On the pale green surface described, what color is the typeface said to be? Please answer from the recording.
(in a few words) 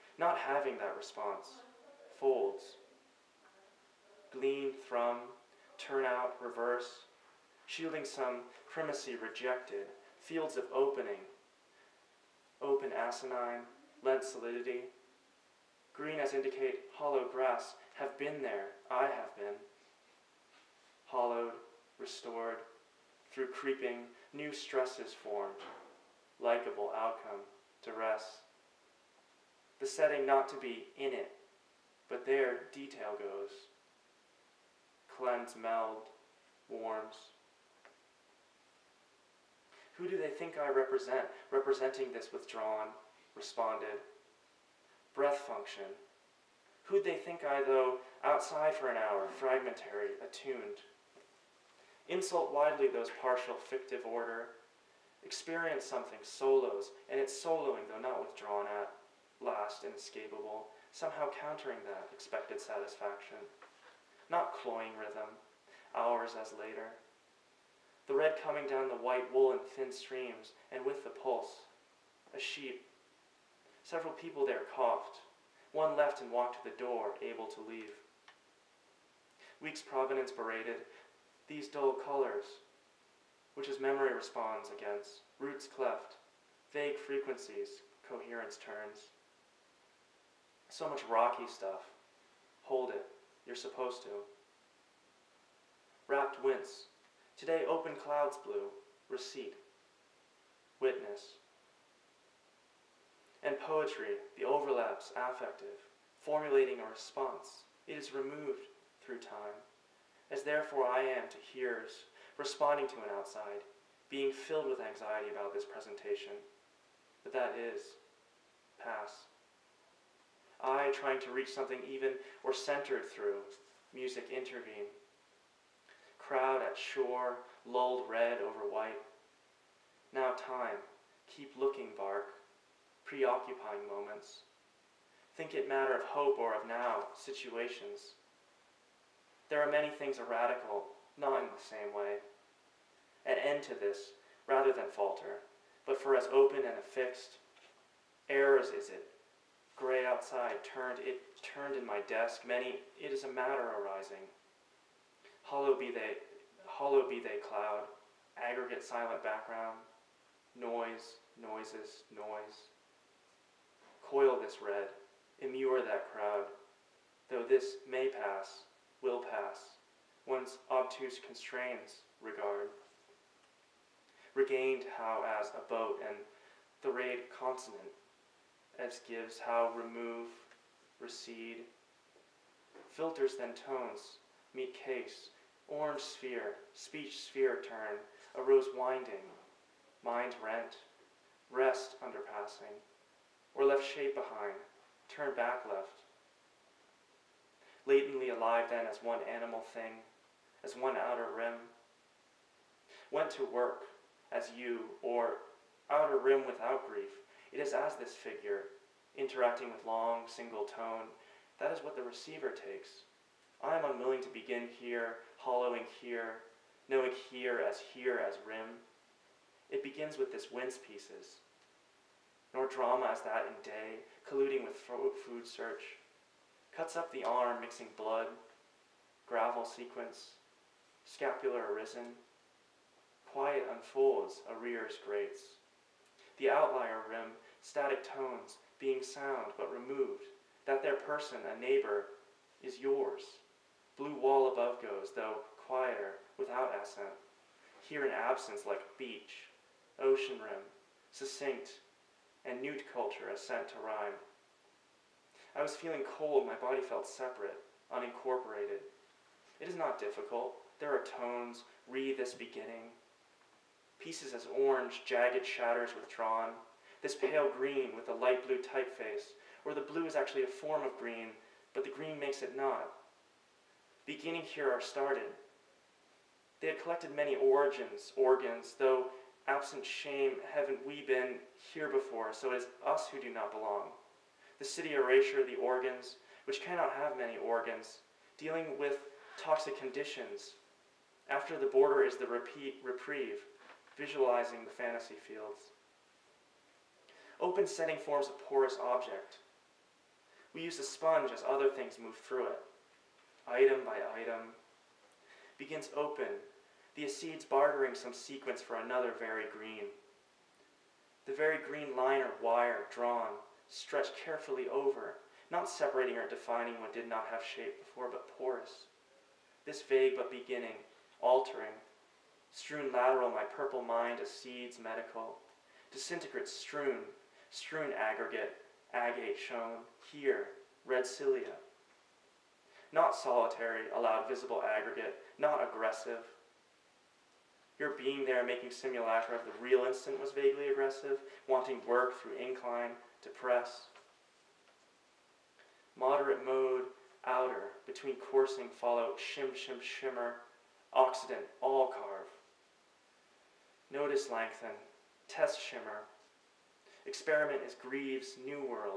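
light blue.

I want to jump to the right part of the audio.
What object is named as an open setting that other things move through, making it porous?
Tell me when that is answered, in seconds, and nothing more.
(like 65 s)
300 s.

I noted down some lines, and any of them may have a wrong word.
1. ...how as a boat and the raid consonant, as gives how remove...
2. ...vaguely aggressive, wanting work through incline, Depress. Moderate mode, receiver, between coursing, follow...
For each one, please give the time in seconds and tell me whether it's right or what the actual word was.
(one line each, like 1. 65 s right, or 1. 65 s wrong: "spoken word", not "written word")
1. 174 s right
2. 340 s wrong: "outer", not "receiver".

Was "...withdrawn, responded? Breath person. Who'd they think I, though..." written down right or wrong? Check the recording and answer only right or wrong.
wrong.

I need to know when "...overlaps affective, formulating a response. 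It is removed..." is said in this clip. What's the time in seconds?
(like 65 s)
104 s.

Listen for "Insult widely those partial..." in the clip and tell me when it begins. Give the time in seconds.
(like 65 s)
52 s.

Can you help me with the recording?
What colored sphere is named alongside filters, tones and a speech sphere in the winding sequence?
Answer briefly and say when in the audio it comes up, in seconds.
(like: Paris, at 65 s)
orange sphere, at 185 s.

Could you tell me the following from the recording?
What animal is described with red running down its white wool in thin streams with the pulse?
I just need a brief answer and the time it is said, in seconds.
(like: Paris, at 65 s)
sheep, at 72 s.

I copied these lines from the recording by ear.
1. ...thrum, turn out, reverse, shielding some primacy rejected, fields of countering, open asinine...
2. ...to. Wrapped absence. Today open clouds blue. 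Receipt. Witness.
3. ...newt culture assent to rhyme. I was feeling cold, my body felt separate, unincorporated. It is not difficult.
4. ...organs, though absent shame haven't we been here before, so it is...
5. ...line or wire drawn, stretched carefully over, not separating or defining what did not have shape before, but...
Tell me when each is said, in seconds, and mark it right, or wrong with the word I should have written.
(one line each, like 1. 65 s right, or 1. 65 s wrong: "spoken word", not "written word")
1. 4 s wrong: "opening", not "countering"
2. 94 s wrong: "wince", not "absence"
3. 252 s right
4. 278 s right
5. 311 s right.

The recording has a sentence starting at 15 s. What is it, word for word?
Green as indicate hollow grass, have been there, I have been.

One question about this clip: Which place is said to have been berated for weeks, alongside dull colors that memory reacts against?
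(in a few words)
Providence.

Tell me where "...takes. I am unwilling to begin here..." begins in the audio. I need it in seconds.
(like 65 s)
212 s.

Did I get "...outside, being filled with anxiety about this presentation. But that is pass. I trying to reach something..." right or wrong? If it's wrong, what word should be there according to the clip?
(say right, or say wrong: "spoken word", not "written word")
right.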